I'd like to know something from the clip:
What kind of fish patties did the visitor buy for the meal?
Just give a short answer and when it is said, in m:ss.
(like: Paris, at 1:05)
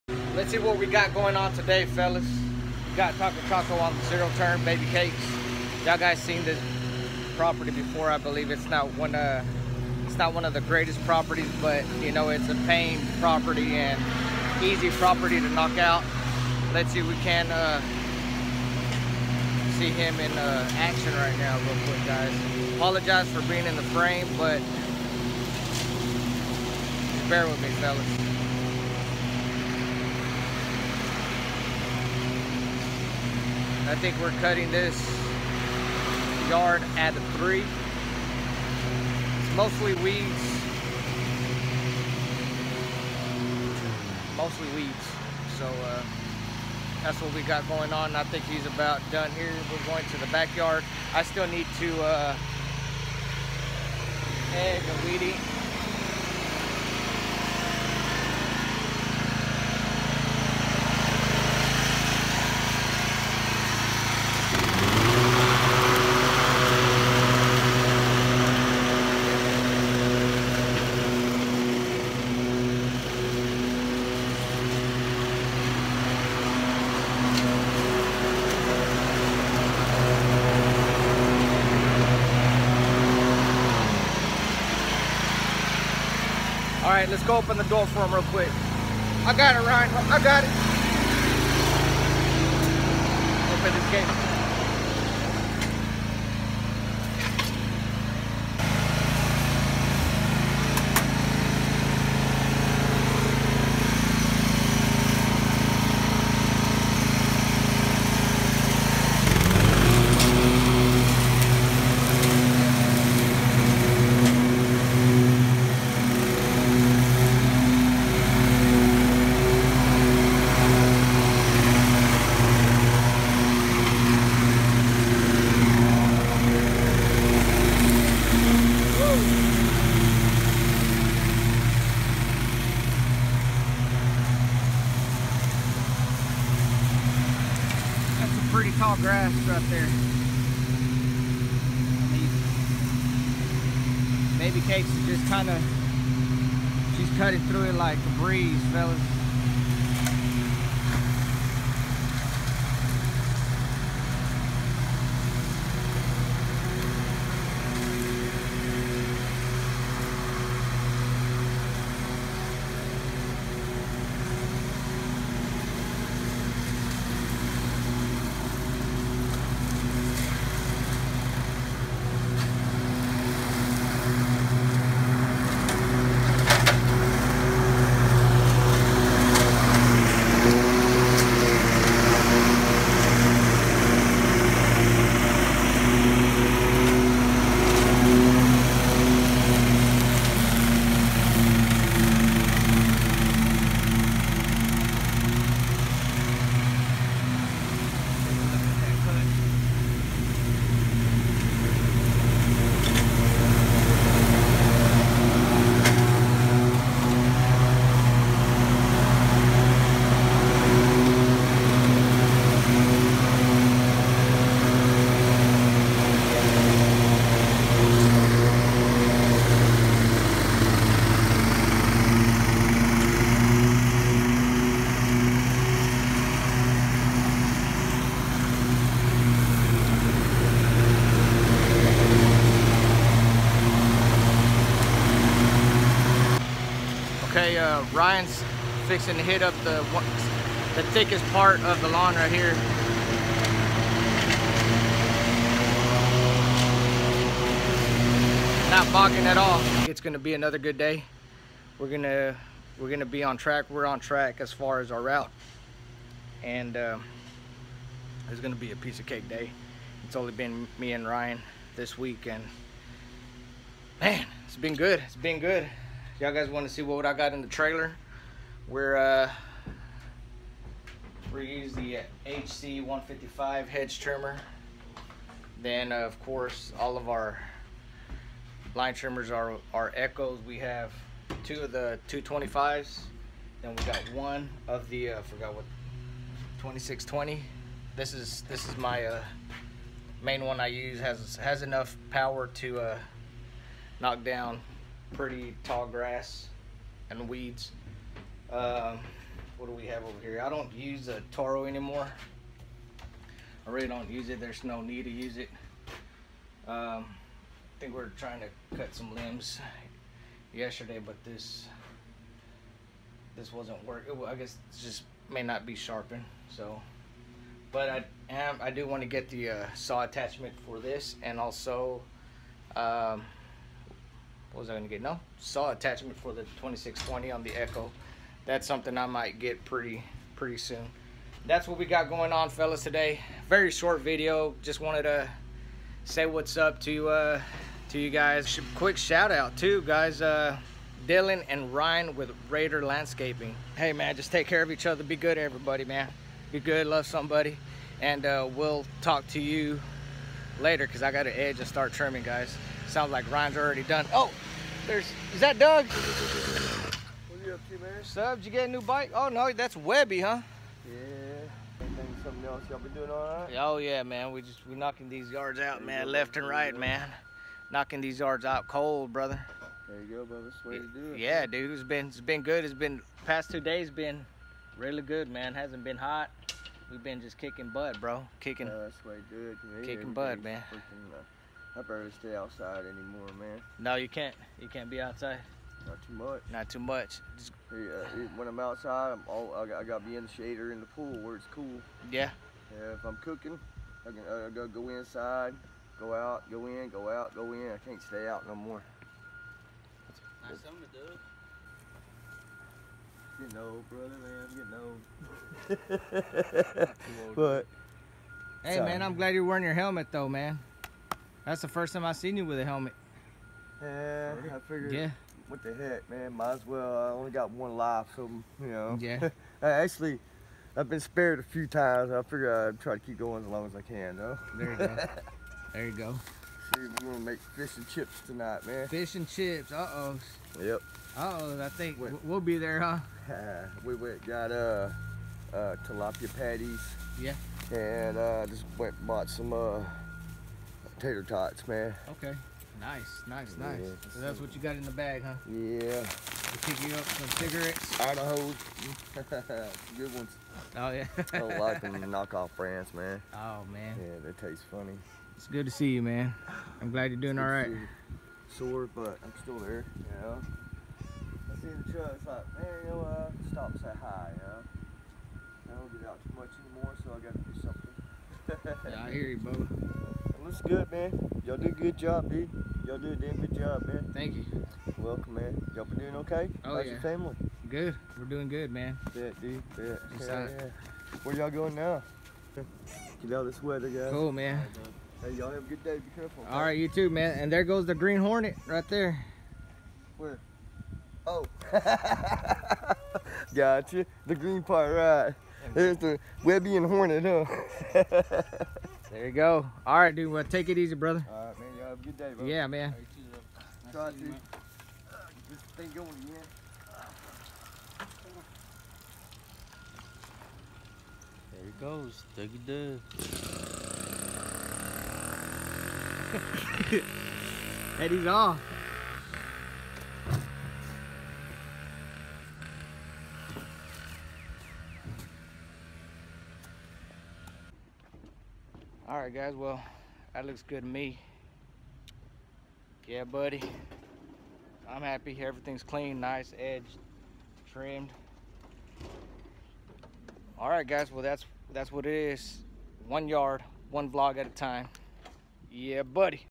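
Tilapia, at 7:15.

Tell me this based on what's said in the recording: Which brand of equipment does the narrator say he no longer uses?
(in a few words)
Toro.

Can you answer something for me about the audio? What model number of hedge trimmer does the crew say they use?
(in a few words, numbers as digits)
HC 155.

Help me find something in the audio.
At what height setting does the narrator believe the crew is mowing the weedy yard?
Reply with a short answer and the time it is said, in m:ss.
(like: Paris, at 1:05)
3, at 0:37.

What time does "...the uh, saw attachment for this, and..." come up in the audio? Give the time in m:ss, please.
5:19.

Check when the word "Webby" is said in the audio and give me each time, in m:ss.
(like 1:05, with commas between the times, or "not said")
5:59, 8:16.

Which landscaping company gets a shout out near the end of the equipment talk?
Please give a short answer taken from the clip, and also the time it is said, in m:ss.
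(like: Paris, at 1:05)
Raider Landscaping, at 5:42.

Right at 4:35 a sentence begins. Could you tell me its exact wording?
Then uh, of course all of our line trimmers are are Echoes.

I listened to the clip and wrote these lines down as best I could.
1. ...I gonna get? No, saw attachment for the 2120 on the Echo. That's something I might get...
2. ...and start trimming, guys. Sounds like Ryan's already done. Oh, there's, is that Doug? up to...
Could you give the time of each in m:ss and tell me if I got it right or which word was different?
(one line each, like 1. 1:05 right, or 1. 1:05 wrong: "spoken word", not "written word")
1. 5:24 wrong: "2620", not "2120"
2. 5:51 right.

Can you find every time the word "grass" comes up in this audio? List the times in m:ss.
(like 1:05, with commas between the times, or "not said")
2:18, 4:55.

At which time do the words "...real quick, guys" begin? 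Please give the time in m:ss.
0:21.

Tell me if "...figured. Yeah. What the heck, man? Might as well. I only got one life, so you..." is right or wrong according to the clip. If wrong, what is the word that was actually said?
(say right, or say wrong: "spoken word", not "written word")
right.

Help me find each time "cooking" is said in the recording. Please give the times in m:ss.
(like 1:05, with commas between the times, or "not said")
6:33.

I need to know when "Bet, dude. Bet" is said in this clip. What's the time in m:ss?
7:59.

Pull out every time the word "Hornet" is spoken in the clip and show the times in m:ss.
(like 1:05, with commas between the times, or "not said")
8:08, 8:16.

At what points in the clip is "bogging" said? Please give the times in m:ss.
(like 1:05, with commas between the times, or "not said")
4:08.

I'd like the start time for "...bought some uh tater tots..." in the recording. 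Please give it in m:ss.
7:19.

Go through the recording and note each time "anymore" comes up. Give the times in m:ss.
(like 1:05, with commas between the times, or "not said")
5:01, 6:22, 7:46.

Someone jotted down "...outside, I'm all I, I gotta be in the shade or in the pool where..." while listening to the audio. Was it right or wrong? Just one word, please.
right.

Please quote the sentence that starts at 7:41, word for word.
I see the truck, it's like, man, you know, uh, stop, say hi, you know.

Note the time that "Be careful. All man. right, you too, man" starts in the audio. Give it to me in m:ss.
8:05.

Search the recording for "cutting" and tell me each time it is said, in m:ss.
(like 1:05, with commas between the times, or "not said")
0:34, 2:27.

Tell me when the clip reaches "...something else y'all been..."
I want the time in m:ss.
6:02.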